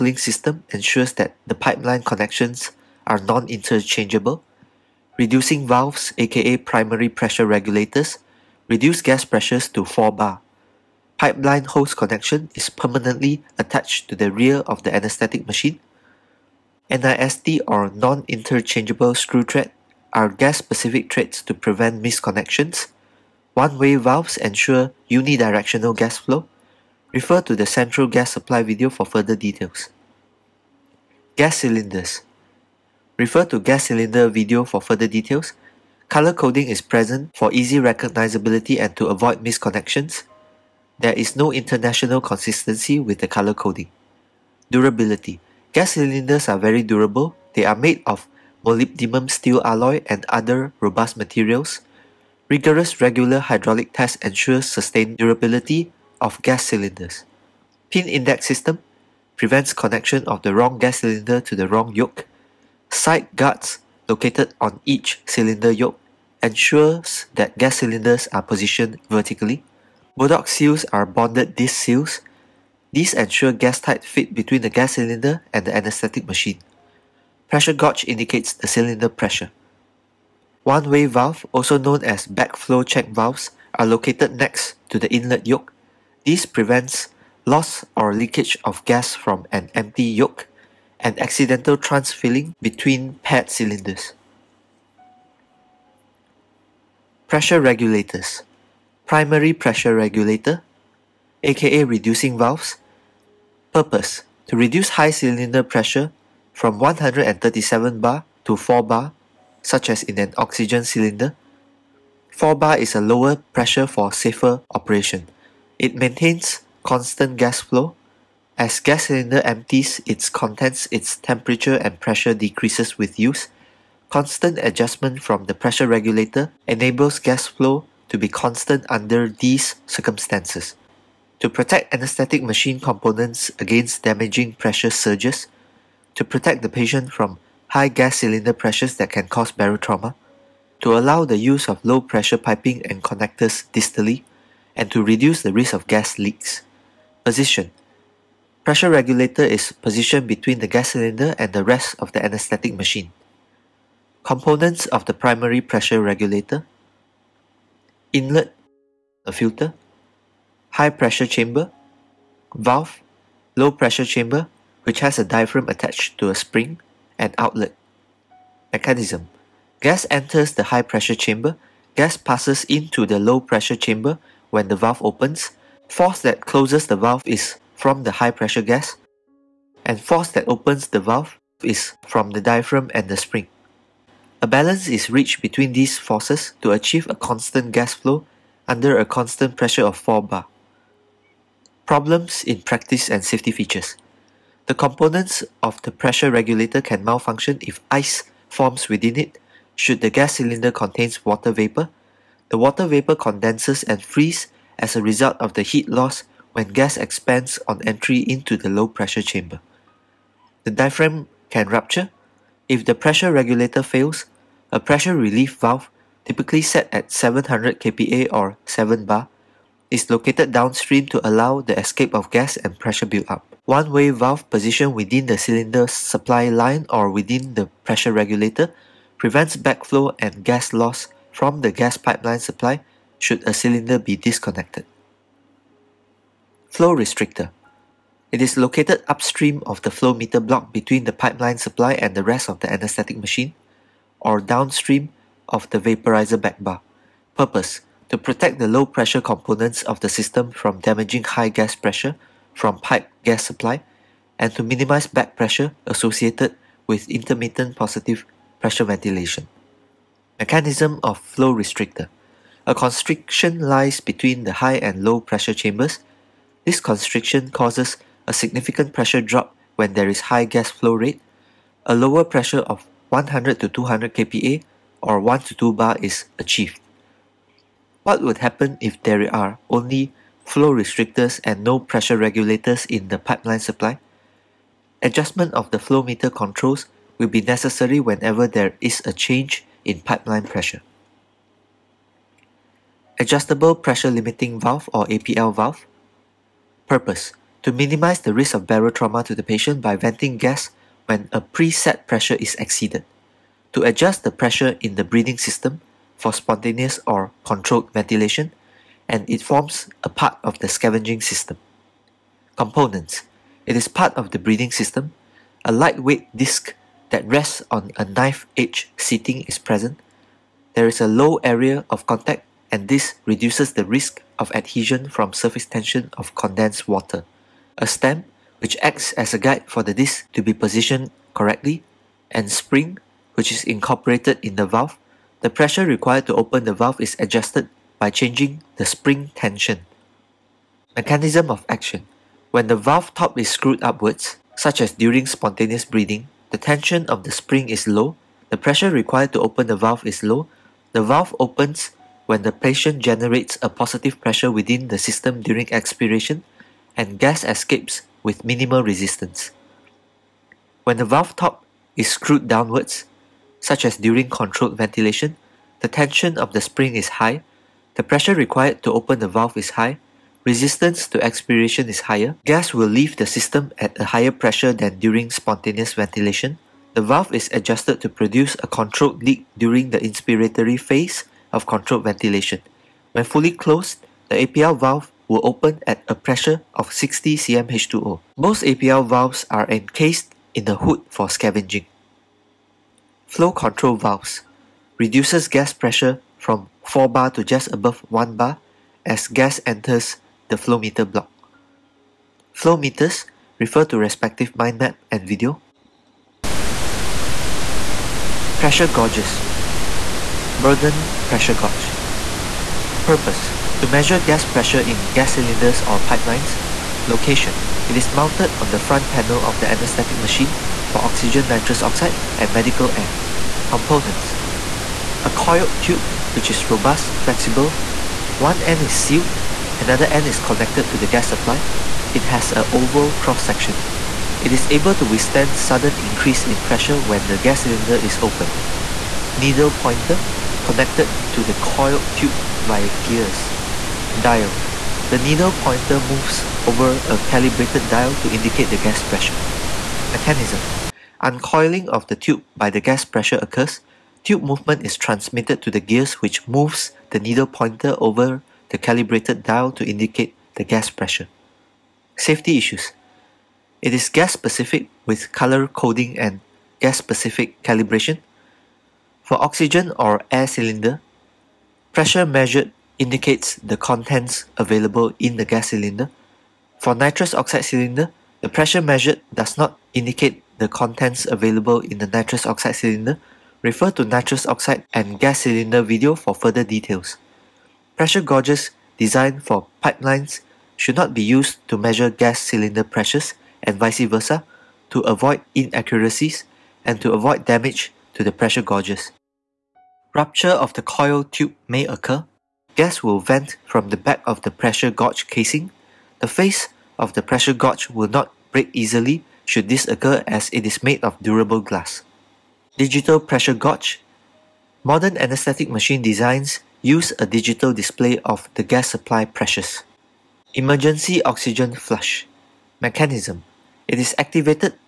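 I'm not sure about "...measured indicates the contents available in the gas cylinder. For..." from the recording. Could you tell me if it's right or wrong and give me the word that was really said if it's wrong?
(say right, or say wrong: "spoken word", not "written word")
right.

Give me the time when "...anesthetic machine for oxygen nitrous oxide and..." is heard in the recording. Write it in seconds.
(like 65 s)
419 s.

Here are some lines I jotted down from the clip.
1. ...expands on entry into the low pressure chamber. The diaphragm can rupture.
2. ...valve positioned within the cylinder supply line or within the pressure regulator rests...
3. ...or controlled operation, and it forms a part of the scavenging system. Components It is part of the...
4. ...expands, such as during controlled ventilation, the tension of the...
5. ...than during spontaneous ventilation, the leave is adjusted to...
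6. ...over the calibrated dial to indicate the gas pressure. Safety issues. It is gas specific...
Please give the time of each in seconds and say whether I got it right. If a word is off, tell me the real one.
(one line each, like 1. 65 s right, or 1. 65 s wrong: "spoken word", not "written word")
1. 206 s right
2. 224 s wrong: "prevents", not "rests"
3. 307 s wrong: "ventilation", not "operation"
4. 362 s wrong: "downwards", not "expands"
5. 374 s wrong: "valve", not "leave"
6. 457 s right.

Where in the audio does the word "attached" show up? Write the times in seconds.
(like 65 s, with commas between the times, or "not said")
13 s, 165 s.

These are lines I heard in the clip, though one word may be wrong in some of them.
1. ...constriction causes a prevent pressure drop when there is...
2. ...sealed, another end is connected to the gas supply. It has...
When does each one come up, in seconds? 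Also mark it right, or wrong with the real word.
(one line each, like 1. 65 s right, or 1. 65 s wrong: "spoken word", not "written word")
1. 266 s wrong: "significant", not "prevent"
2. 428 s right.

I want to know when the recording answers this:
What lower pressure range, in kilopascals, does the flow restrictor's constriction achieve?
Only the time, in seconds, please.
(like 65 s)
273 s.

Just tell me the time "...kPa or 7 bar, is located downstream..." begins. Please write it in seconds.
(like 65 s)
217 s.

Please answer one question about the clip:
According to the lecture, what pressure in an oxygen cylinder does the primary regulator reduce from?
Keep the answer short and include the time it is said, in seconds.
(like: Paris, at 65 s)
137 bar, at 106 s.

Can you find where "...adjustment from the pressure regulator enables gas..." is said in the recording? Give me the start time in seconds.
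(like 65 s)
124 s.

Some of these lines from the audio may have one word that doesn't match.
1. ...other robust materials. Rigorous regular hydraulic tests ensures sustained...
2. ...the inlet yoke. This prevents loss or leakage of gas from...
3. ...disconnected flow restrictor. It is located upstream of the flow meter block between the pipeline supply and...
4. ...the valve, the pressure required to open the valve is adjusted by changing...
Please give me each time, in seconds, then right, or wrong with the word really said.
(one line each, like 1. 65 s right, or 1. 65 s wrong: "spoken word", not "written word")
1. 50 s right
2. 85 s right
3. 234 s right
4. 334 s right.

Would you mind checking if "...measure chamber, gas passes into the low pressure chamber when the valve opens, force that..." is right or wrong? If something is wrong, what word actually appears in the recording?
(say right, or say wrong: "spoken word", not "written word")
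wrong: "pressure", not "measure".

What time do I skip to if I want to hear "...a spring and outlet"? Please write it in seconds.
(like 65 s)
166 s.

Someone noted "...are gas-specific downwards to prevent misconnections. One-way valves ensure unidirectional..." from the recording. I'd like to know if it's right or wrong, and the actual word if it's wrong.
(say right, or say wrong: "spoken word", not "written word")
wrong: "threads", not "downwards".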